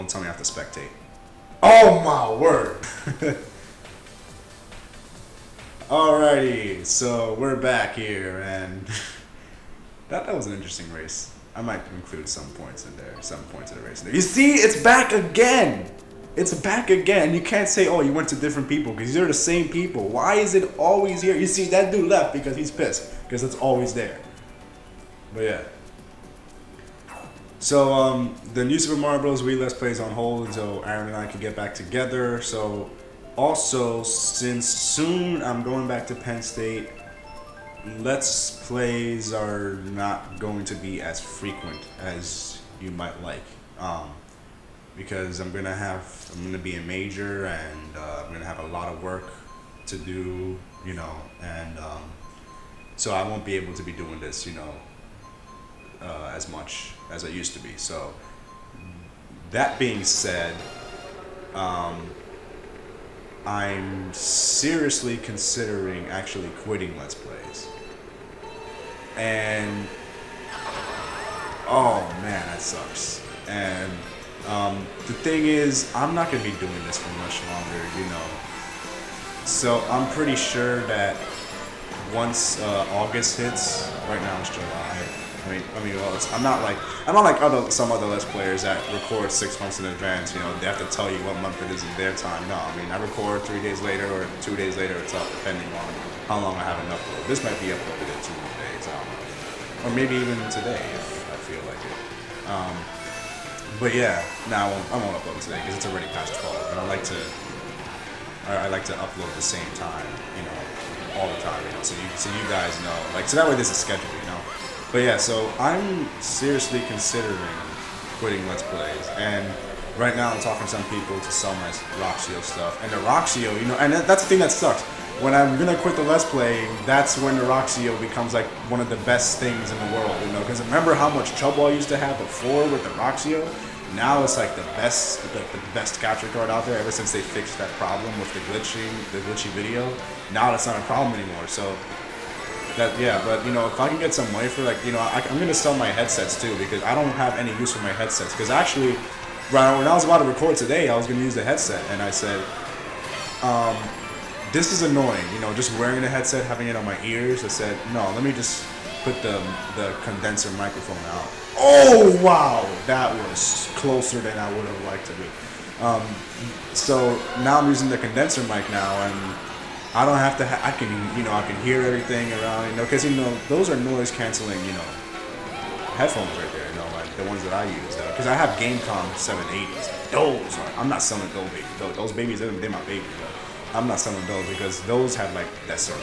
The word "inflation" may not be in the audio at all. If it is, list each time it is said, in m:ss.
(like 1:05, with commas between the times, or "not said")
not said.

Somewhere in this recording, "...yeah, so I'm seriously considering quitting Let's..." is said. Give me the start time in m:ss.
1:55.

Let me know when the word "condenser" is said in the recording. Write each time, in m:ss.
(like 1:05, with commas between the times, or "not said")
2:40, 2:47.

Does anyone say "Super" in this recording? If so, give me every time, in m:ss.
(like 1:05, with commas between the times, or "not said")
0:28.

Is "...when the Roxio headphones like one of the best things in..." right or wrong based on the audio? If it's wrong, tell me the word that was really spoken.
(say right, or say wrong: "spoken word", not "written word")
wrong: "becomes", not "headphones".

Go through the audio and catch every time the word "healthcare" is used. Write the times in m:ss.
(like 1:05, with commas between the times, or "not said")
not said.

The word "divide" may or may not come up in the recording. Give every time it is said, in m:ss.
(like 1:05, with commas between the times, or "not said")
not said.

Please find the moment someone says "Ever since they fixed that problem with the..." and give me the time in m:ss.
2:16.